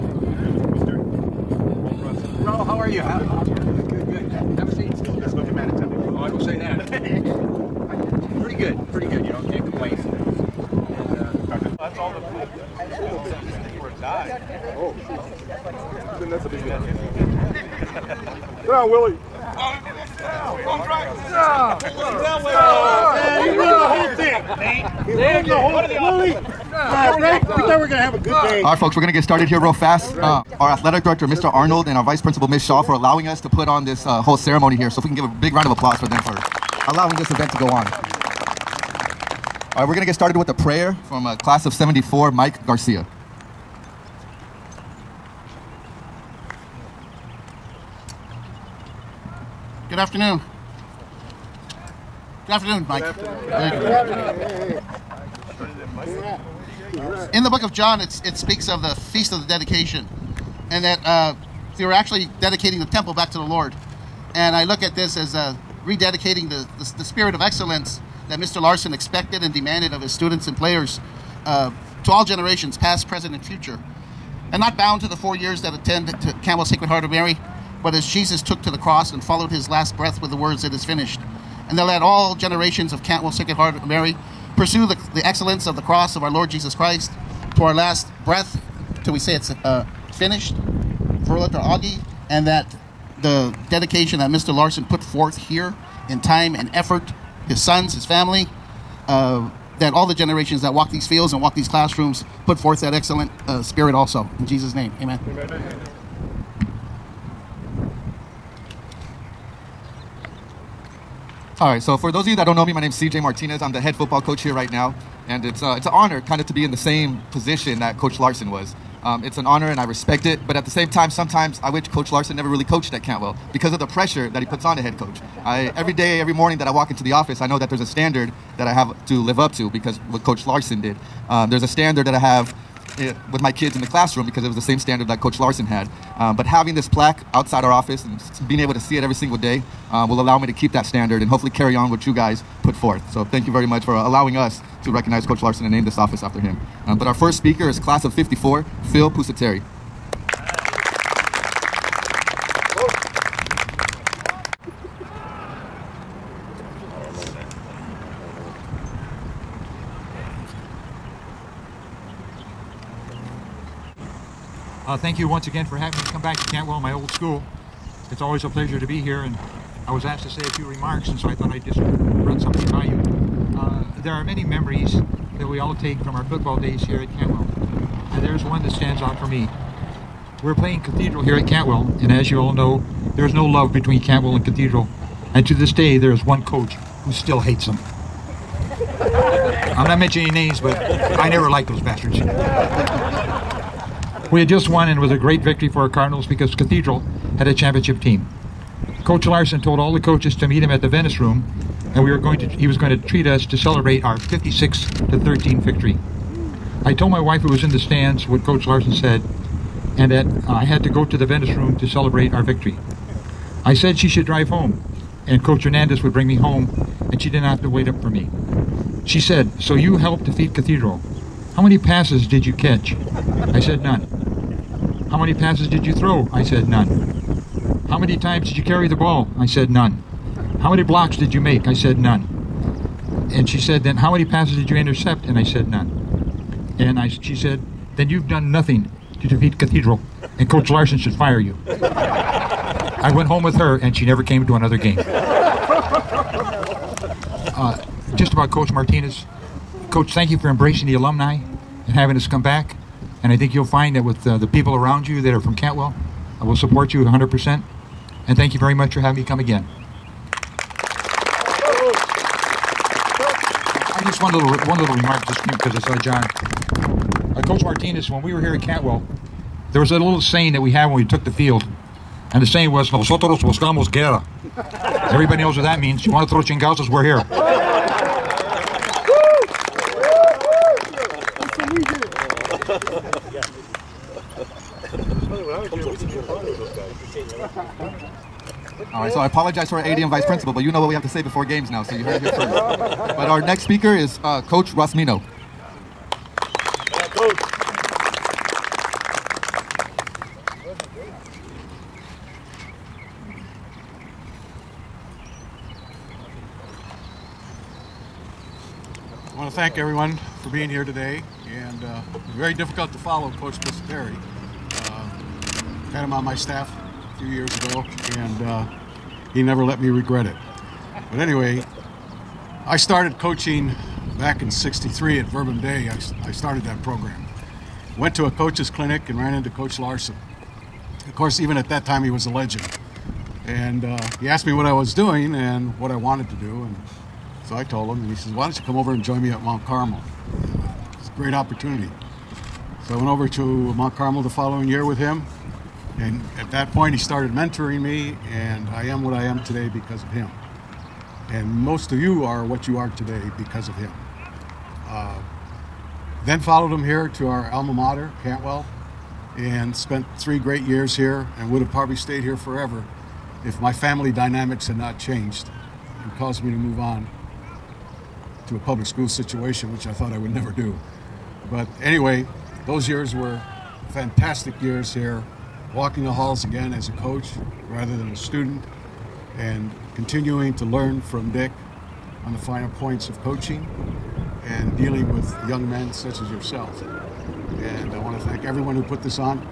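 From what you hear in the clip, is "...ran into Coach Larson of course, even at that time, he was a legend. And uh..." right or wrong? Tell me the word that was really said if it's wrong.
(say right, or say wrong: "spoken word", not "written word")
right.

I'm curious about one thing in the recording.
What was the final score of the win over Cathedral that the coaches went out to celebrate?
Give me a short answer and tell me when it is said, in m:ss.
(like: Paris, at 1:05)
56 to 13, at 3:24.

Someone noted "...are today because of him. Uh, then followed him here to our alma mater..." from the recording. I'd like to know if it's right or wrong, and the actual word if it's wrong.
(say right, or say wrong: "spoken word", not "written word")
right.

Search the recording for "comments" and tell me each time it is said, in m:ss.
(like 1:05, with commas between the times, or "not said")
not said.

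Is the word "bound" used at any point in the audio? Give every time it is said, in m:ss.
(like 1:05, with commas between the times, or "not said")
1:14.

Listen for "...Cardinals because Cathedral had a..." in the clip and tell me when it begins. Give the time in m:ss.
3:15.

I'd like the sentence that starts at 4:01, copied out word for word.
I went home with her, and she never came to another game.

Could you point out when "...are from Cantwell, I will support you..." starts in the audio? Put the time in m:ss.
4:15.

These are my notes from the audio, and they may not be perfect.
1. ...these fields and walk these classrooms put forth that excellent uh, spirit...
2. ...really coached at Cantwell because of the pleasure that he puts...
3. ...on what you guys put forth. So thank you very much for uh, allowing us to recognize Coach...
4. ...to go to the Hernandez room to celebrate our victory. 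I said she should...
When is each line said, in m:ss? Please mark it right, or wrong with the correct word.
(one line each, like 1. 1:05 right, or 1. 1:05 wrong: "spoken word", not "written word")
1. 1:40 right
2. 2:02 wrong: "pressure", not "pleasure"
3. 2:21 right
4. 3:30 wrong: "Venice", not "Hernandez".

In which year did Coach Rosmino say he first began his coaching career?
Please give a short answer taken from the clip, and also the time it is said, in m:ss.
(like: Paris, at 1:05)
1963, at 5:24.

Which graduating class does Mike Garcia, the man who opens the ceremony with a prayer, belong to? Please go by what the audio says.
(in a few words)
Class of 74.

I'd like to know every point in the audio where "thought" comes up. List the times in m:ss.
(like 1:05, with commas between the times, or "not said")
0:27, 2:51, 6:09.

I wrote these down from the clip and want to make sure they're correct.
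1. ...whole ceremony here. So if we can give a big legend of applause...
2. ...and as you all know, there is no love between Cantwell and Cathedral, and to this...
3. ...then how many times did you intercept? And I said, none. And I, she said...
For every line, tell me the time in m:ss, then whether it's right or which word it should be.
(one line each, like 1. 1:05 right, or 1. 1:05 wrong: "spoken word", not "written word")
1. 0:34 wrong: "round", not "legend"
2. 3:01 right
3. 3:53 wrong: "passes", not "times".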